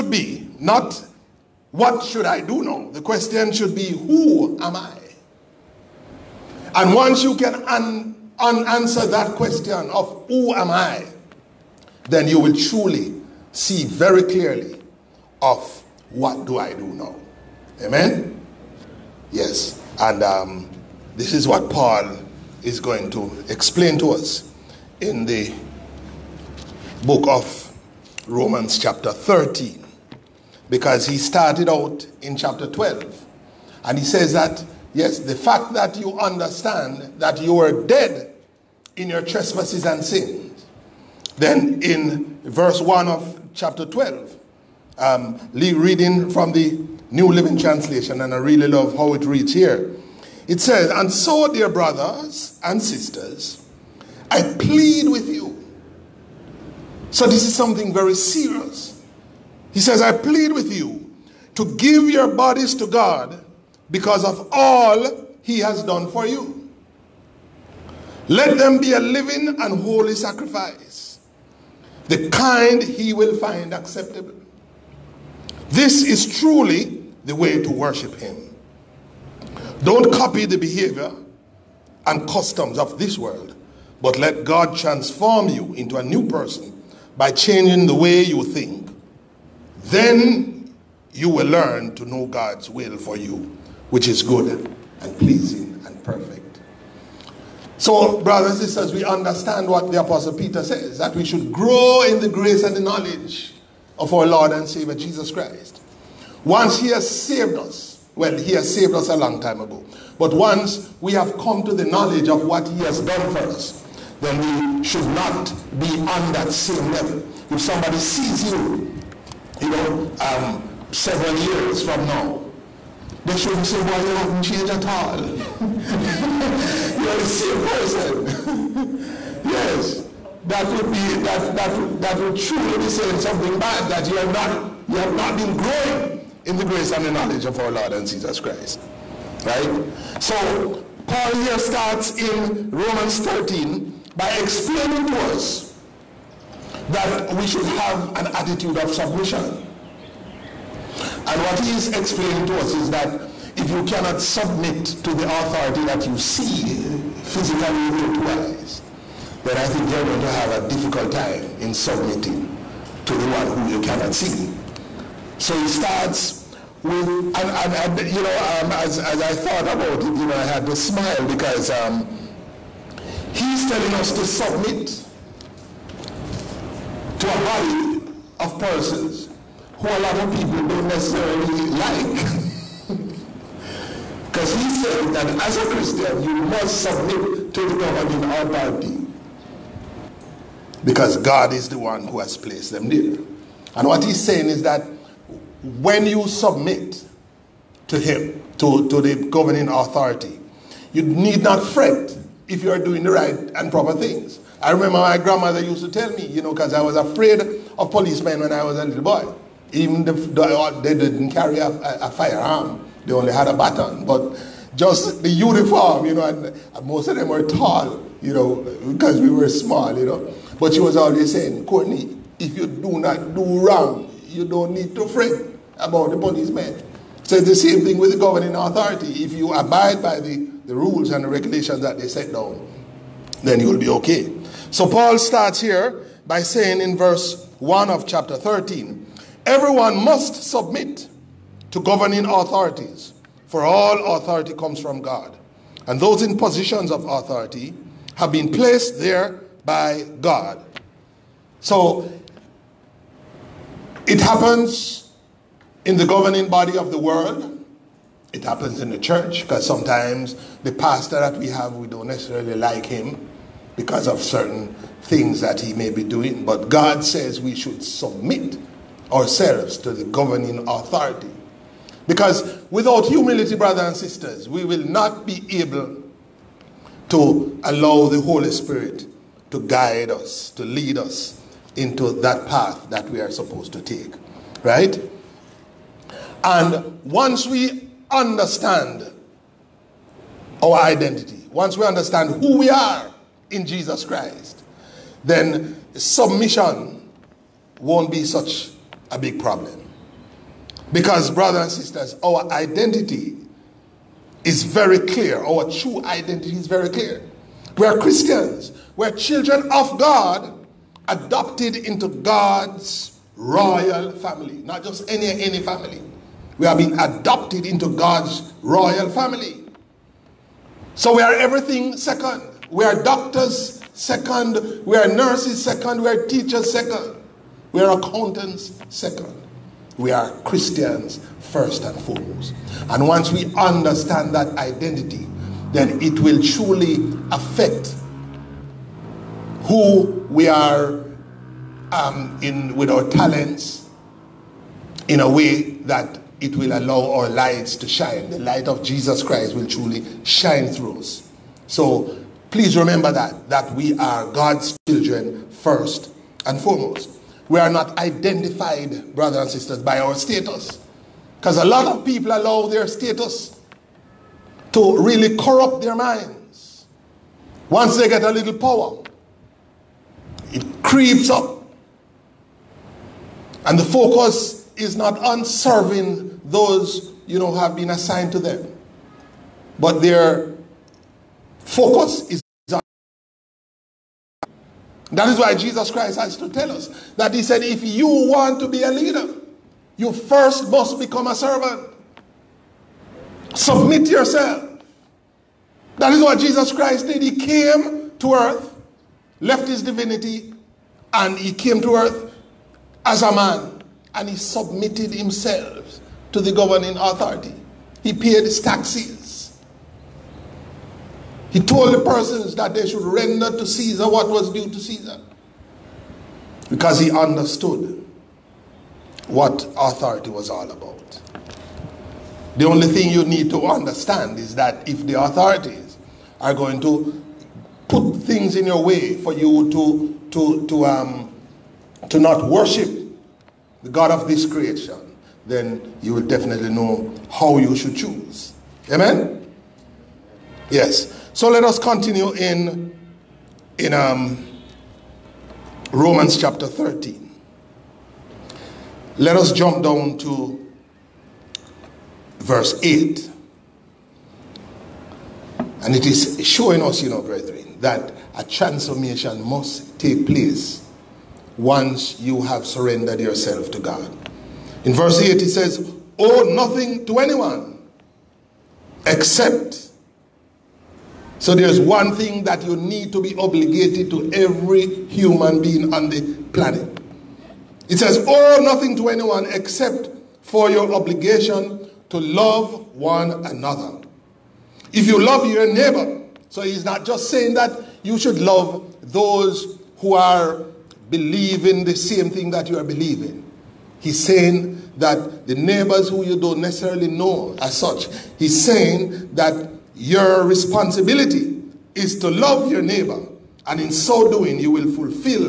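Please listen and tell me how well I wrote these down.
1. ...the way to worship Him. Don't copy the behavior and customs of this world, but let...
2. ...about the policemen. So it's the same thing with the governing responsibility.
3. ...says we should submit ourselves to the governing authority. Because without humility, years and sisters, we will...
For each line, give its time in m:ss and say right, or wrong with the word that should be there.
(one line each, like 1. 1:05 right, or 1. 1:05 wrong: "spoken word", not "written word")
1. 1:17 right
2. 3:45 wrong: "authority", not "responsibility"
3. 4:27 wrong: "brothers", not "years".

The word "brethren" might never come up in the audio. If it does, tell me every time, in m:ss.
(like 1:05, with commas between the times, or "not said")
7:37.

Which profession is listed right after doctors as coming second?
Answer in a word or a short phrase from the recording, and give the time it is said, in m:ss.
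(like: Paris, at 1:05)
Nurses, at 5:25.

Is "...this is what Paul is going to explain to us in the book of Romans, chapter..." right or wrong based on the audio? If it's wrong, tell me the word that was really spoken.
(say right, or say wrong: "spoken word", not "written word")
right.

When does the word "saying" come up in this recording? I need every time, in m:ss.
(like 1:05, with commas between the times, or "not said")
2:12, 3:14, 3:41, 3:56, 8:07, 8:14, 8:18.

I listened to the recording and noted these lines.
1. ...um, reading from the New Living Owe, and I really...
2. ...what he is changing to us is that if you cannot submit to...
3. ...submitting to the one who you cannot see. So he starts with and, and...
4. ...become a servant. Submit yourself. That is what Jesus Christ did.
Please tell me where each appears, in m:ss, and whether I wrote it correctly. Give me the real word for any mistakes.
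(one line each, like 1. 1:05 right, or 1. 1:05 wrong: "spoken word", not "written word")
1. 0:44 wrong: "Translation", not "Owe"
2. 2:31 wrong: "explaining", not "changing"
3. 2:41 right
4. 6:30 right.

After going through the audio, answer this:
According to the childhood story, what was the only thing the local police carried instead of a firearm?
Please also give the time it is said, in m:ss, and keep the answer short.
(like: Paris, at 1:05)
A baton, at 3:33.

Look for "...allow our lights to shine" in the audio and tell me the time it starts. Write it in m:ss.
5:46.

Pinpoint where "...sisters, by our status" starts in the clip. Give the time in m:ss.
5:59.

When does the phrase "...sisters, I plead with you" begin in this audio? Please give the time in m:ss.
0:52.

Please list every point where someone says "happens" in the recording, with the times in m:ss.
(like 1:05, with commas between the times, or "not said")
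4:14, 4:18.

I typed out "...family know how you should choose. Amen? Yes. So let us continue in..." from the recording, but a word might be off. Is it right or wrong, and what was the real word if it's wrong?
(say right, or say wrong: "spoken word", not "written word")
wrong: "definitely", not "family".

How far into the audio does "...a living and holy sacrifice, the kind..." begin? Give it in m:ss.
1:08.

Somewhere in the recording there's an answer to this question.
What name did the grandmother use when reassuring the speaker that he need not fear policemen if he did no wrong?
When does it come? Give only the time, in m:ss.
3:41.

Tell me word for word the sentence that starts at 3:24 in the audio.
I remember my grandmother used to tell me, you know, because I was afraid of policemen when I was a little boy.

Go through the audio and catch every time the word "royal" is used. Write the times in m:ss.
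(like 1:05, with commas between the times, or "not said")
5:13, 5:18.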